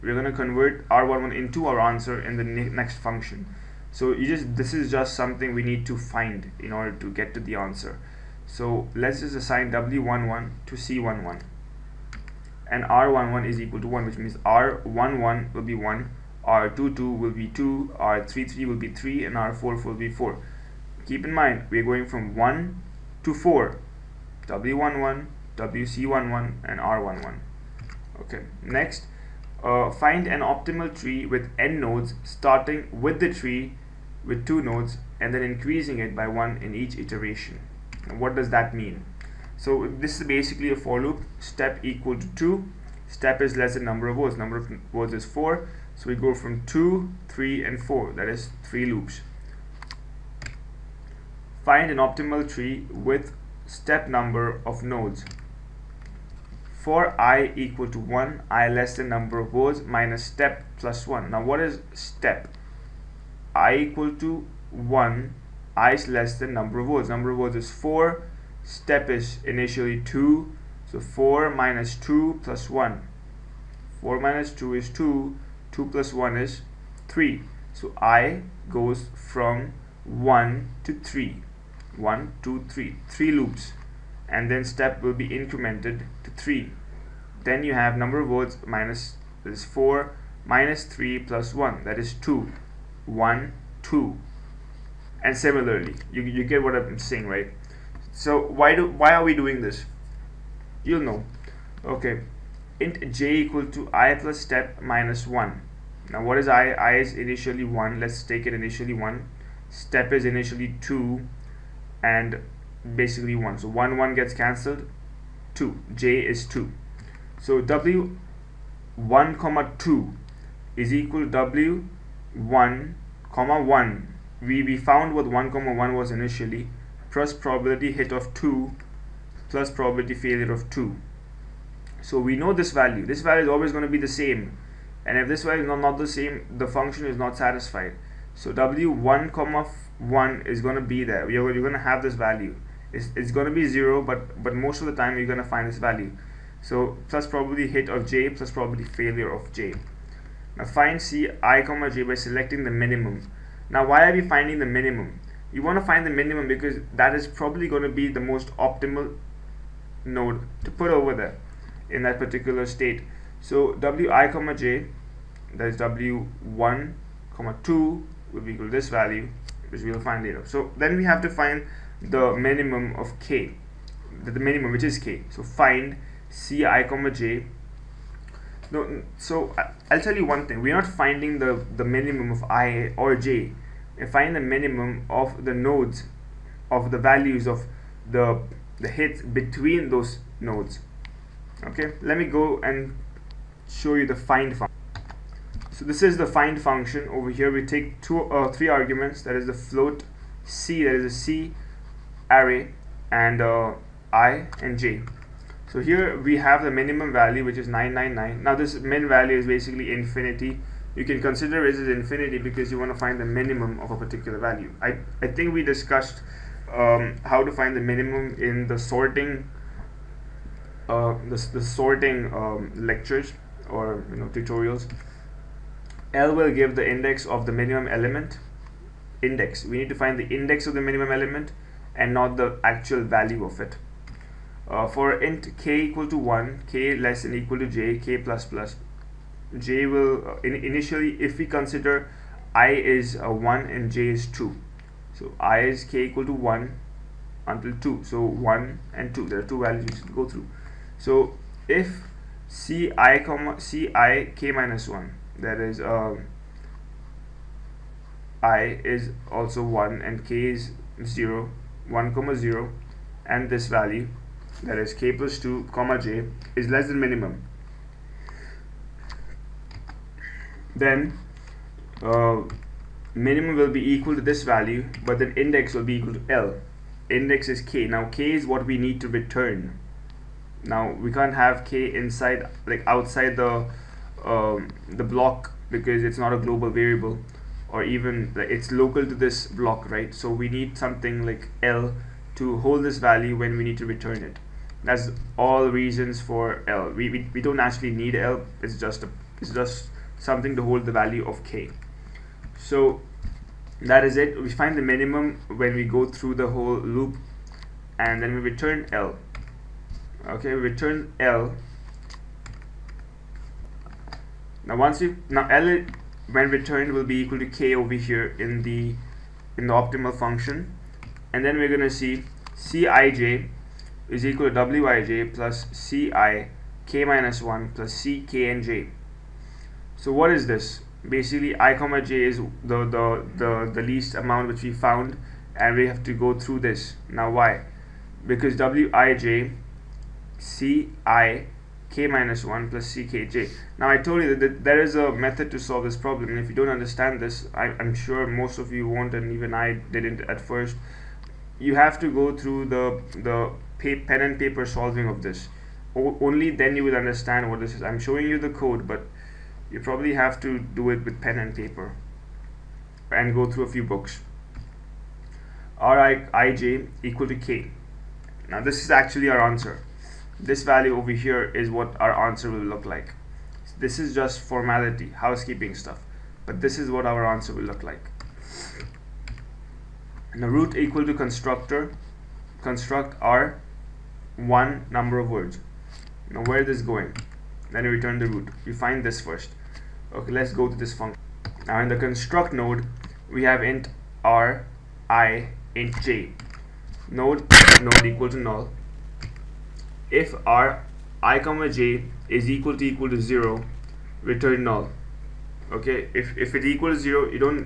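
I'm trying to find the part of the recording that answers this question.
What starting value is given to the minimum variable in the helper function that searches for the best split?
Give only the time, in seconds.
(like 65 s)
207 s.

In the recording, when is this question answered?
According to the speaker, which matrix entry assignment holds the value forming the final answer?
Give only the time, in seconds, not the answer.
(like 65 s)
365 s.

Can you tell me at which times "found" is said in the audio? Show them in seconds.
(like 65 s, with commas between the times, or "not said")
124 s, 334 s.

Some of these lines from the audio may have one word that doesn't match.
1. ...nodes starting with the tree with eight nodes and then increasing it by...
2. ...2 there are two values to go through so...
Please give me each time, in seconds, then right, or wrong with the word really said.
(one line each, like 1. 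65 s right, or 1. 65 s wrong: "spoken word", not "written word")
1. 31 s wrong: "two", not "eight"
2. 249 s right.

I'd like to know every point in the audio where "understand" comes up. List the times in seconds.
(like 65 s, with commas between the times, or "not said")
346 s, 356 s.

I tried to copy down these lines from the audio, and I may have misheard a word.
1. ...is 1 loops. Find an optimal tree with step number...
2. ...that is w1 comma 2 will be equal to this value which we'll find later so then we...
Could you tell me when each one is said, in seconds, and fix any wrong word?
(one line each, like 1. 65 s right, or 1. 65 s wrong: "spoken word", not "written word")
1. 48 s wrong: "3", not "1"
2. 165 s right.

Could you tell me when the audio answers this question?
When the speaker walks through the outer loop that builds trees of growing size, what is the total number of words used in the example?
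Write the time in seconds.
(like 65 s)
44 s.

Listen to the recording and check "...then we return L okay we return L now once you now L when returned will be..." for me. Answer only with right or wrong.
right.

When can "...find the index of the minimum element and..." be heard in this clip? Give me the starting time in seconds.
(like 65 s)
229 s.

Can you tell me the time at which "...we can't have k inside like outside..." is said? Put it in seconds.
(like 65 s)
280 s.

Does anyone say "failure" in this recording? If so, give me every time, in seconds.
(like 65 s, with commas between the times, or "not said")
130 s, 148 s.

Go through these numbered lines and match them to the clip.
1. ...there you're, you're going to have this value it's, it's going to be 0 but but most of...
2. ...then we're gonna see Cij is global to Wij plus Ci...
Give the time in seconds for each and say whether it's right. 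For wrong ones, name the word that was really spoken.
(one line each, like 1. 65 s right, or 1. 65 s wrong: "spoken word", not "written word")
1. 141 s right
2. 321 s wrong: "equal", not "global".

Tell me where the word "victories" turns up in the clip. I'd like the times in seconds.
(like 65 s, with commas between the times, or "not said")
not said.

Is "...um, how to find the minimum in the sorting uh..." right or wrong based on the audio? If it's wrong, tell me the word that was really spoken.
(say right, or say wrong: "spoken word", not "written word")
right.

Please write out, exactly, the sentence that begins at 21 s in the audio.
Keep in mind we're going from 1 to 4 W11, WC11, and R11.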